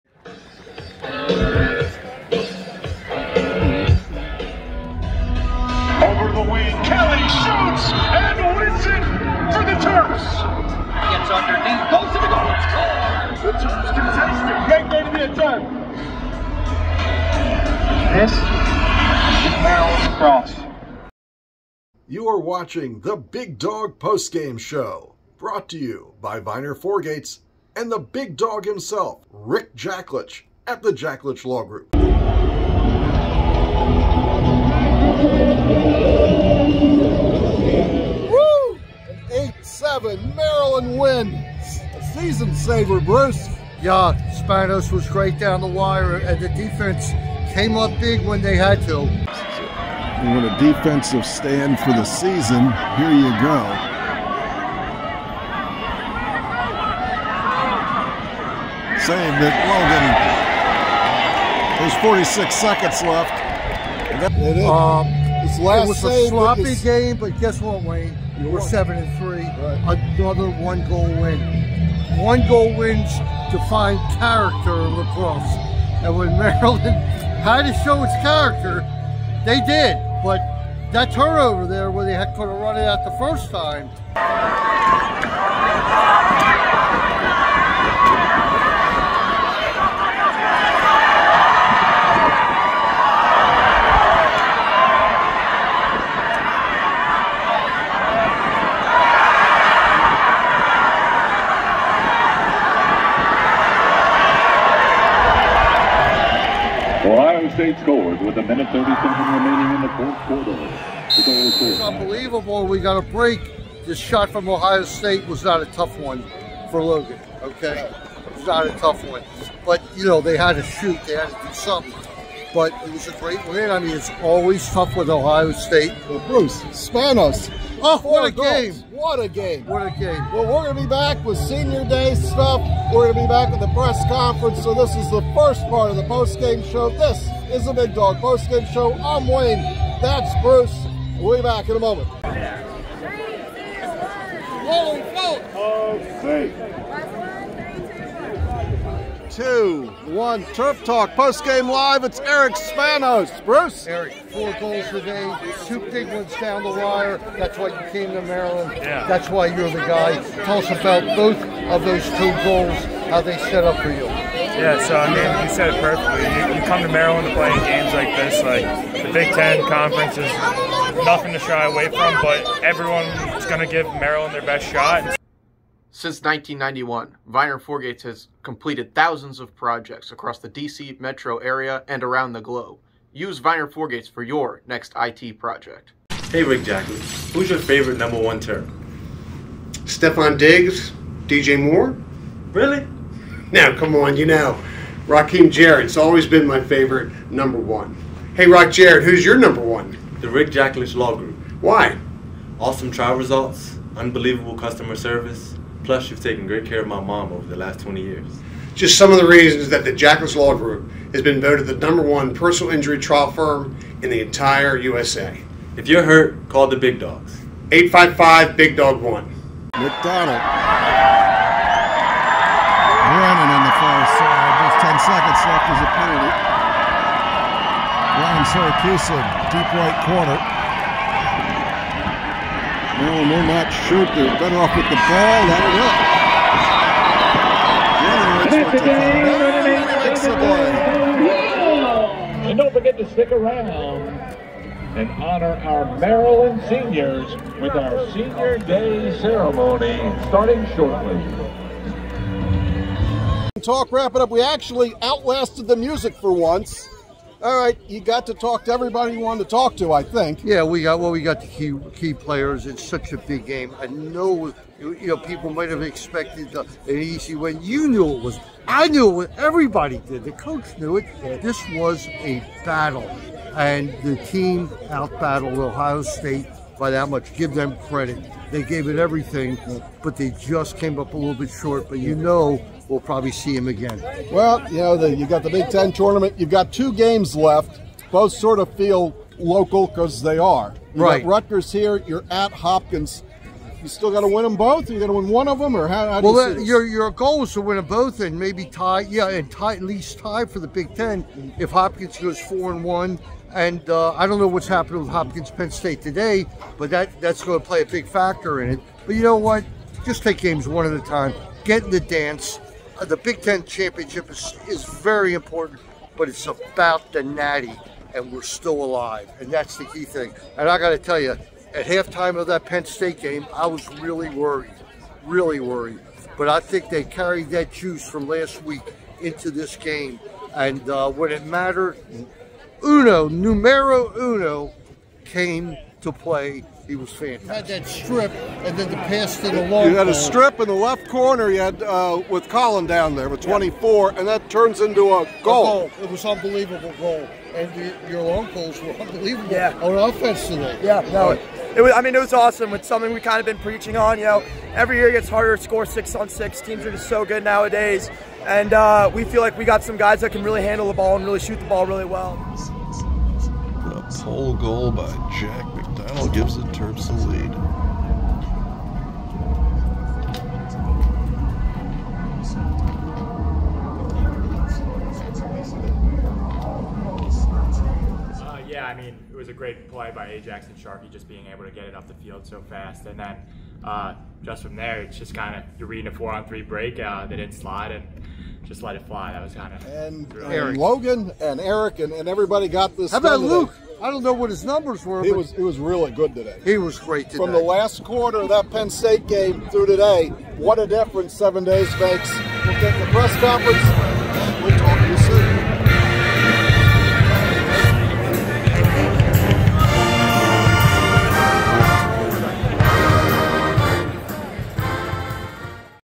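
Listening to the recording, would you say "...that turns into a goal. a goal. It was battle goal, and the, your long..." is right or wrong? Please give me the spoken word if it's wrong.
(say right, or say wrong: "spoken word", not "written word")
wrong: "unbelievable", not "battle".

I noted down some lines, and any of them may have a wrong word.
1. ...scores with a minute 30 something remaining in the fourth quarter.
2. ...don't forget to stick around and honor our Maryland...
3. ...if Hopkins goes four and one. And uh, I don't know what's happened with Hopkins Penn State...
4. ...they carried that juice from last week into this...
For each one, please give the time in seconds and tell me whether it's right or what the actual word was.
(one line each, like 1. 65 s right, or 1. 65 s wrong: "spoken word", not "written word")
1. 107 s right
2. 242 s right
3. 301 s right
4. 326 s right.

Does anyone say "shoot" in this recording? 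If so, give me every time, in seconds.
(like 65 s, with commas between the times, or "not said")
120 s, 233 s, 361 s.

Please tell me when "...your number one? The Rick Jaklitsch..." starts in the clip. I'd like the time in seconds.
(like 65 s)
199 s.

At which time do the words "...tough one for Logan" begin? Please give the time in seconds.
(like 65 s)
115 s.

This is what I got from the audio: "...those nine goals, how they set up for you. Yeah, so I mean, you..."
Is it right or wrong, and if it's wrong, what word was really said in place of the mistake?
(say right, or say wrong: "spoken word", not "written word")
wrong: "two", not "nine".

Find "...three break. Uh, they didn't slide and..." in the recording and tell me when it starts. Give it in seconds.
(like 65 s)
386 s.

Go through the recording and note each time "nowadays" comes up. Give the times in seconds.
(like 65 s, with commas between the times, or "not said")
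357 s.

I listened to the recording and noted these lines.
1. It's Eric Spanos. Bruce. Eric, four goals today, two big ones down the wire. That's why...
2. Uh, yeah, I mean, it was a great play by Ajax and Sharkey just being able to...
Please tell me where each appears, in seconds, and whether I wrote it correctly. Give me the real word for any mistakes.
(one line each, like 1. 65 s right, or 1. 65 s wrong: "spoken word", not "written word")
1. 152 s right
2. 378 s right.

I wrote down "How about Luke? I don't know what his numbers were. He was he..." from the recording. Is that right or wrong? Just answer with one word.
right.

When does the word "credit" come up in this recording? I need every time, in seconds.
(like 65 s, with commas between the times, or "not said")
277 s.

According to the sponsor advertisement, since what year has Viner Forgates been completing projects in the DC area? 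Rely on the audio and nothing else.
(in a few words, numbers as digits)
1991.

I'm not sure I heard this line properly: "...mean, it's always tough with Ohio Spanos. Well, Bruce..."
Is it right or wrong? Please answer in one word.
wrong.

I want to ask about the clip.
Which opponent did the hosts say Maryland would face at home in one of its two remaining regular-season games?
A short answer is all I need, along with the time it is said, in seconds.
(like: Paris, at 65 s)
Rutgers, at 291 s.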